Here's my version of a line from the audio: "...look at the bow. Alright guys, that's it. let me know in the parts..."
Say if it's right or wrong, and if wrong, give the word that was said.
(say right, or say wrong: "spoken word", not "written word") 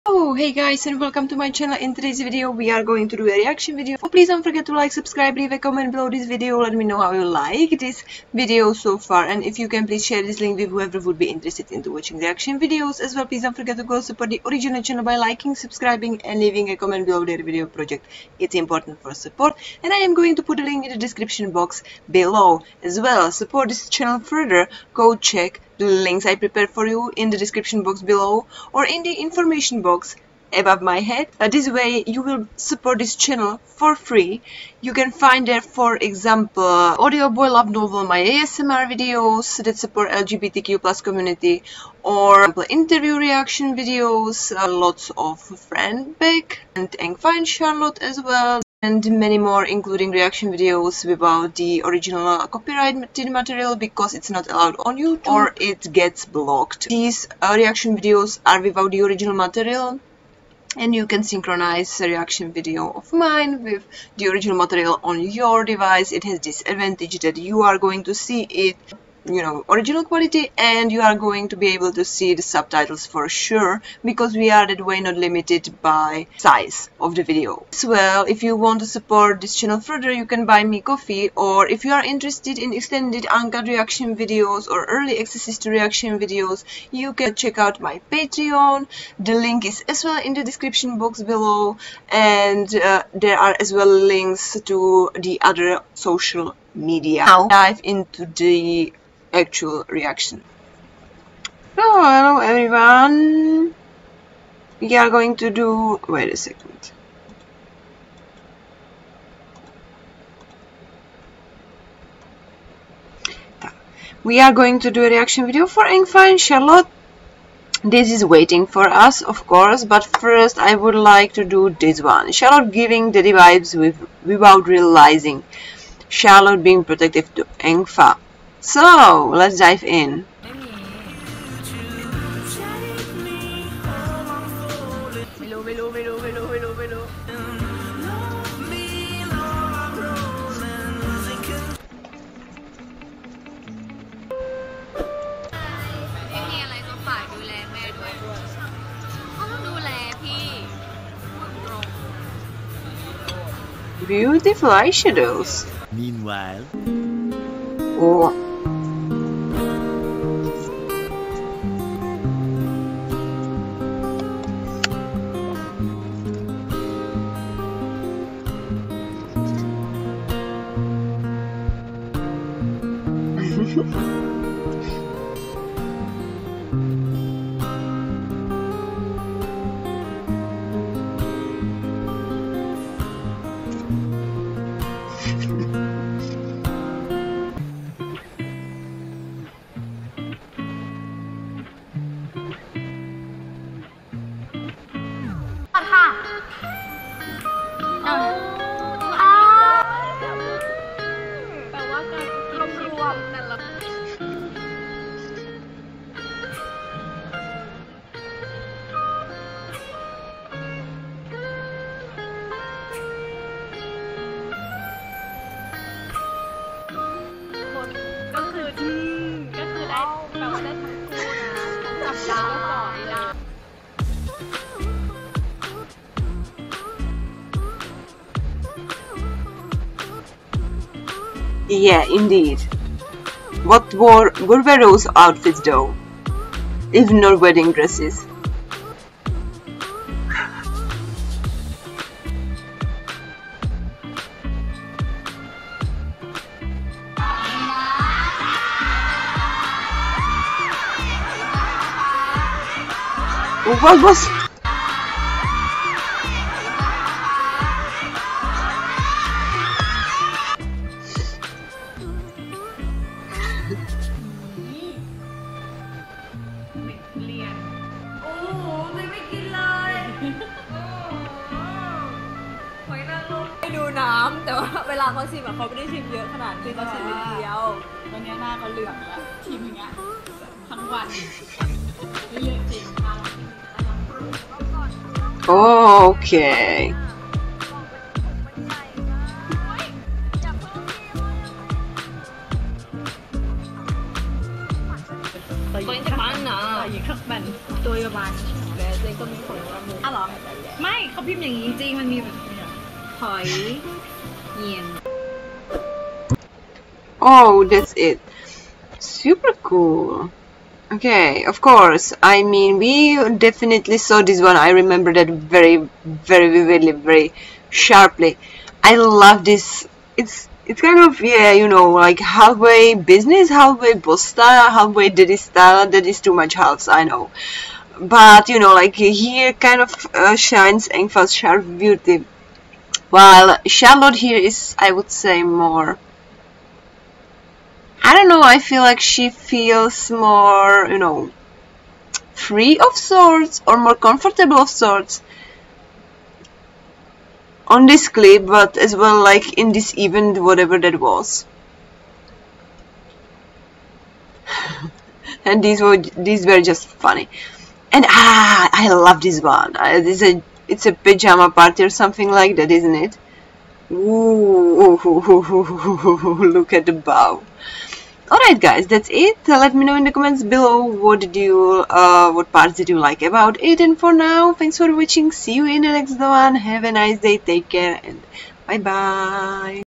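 wrong: "comments", not "parts".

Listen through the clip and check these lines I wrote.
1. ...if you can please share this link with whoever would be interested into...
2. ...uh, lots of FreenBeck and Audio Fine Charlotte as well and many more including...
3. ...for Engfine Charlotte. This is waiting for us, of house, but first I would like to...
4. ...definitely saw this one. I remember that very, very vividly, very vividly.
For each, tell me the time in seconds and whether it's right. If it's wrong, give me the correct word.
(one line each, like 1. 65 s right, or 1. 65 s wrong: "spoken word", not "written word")
1. 9 s right
2. 44 s wrong: "Eng", not "Audio"
3. 115 s wrong: "course", not "house"
4. 313 s wrong: "sharply", not "vividly".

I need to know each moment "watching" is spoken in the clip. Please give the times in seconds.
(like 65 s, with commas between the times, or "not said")
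11 s, 374 s.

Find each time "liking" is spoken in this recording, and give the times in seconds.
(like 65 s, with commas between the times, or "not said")
15 s.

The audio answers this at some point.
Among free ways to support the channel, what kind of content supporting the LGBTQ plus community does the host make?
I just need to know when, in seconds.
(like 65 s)
38 s.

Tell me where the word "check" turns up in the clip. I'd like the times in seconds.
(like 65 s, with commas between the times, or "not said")
25 s, 87 s.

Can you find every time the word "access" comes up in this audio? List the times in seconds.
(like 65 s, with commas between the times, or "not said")
85 s.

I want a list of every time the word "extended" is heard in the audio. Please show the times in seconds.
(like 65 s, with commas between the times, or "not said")
82 s.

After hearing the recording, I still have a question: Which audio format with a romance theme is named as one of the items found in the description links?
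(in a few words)
Audio Boy Love Novel.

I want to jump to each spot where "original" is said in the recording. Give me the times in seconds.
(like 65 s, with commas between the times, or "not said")
14 s, 51 s, 59 s, 64 s, 69 s.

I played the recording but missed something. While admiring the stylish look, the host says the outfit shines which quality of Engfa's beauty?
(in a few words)
Sharp.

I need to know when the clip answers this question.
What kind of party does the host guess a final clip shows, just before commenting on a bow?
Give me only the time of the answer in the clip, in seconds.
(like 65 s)
360 s.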